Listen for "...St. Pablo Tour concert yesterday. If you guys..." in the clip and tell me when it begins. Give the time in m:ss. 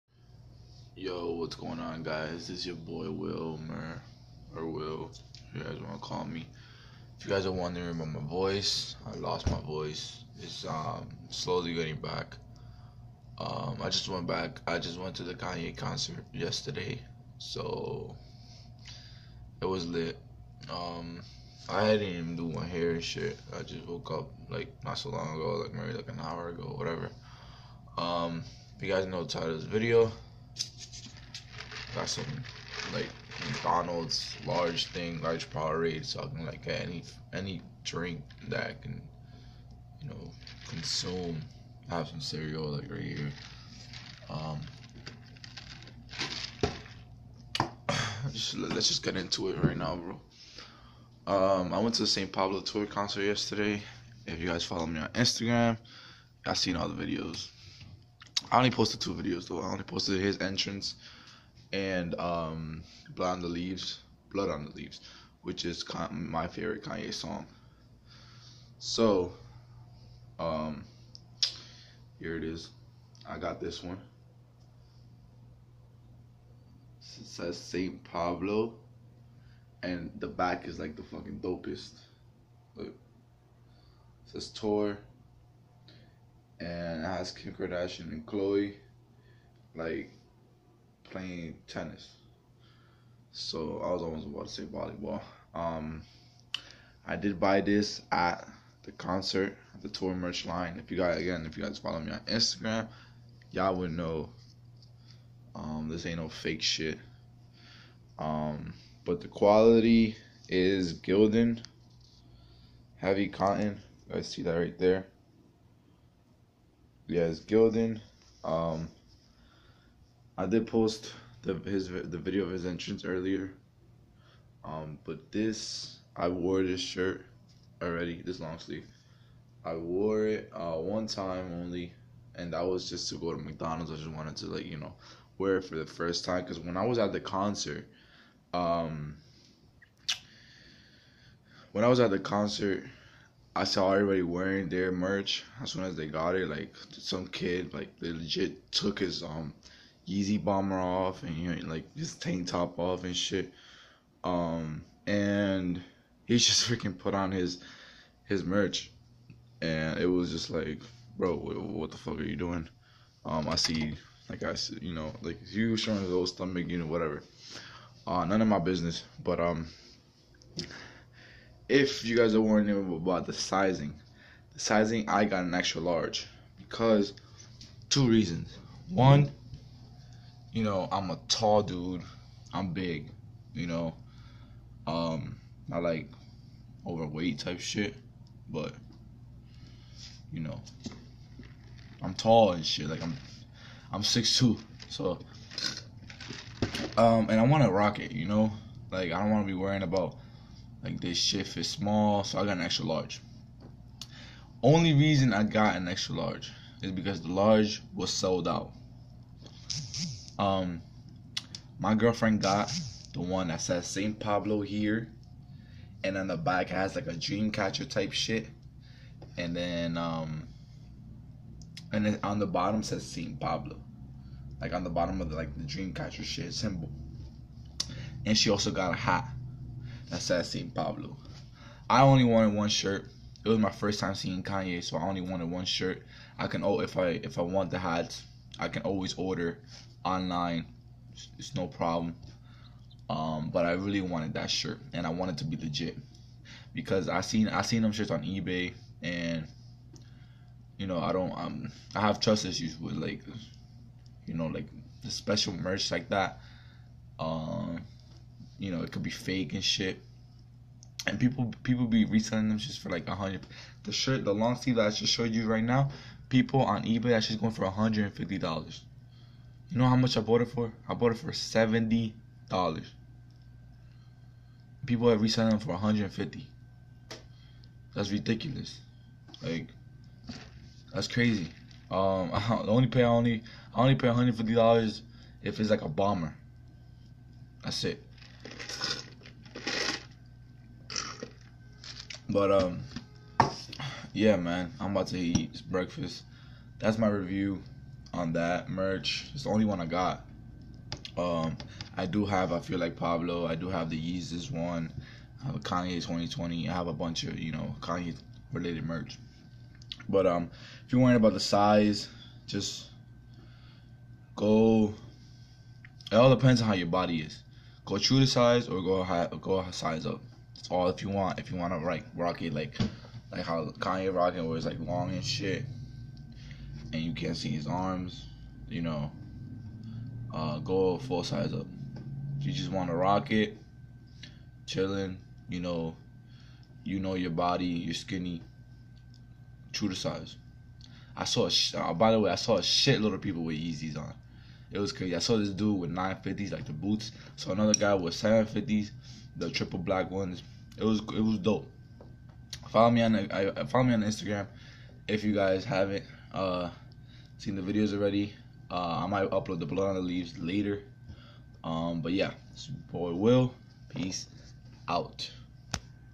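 0:52.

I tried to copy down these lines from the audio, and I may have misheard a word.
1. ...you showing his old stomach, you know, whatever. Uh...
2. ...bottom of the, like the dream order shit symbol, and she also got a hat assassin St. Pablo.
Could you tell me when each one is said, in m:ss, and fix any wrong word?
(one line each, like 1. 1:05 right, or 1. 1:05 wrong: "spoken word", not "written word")
1. 2:45 right
2. 3:44 wrong: "catcher", not "order".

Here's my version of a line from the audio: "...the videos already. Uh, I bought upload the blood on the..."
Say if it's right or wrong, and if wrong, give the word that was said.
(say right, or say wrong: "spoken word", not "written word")
wrong: "might", not "bought".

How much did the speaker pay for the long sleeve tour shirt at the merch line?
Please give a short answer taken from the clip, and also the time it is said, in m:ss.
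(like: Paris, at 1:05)
$70, at 4:31.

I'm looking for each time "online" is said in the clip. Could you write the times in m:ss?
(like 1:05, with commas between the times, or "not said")
4:00.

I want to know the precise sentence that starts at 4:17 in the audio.
Um, you know it could be fake and shit.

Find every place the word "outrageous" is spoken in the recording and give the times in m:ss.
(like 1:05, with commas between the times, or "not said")
not said.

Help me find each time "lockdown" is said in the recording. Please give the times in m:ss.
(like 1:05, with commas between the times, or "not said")
not said.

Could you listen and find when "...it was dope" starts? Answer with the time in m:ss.
5:50.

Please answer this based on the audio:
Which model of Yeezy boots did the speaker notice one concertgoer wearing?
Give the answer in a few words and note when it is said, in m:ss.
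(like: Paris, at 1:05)
950s, at 5:45.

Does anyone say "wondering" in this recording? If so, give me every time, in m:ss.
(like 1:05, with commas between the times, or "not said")
0:07, 2:52.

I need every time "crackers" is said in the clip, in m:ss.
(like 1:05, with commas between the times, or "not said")
not said.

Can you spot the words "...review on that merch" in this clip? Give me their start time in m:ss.
4:57.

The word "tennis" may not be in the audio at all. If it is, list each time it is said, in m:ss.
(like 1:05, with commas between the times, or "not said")
1:31.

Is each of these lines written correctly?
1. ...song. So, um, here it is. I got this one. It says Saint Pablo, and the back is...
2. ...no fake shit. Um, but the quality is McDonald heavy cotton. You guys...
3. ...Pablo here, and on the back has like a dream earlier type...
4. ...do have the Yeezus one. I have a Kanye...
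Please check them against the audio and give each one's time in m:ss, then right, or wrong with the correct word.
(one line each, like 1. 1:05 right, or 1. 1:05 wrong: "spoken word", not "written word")
1. 1:07 right
2. 1:46 wrong: "Gildan", not "McDonald"
3. 3:34 wrong: "catcher", not "earlier"
4. 5:03 right.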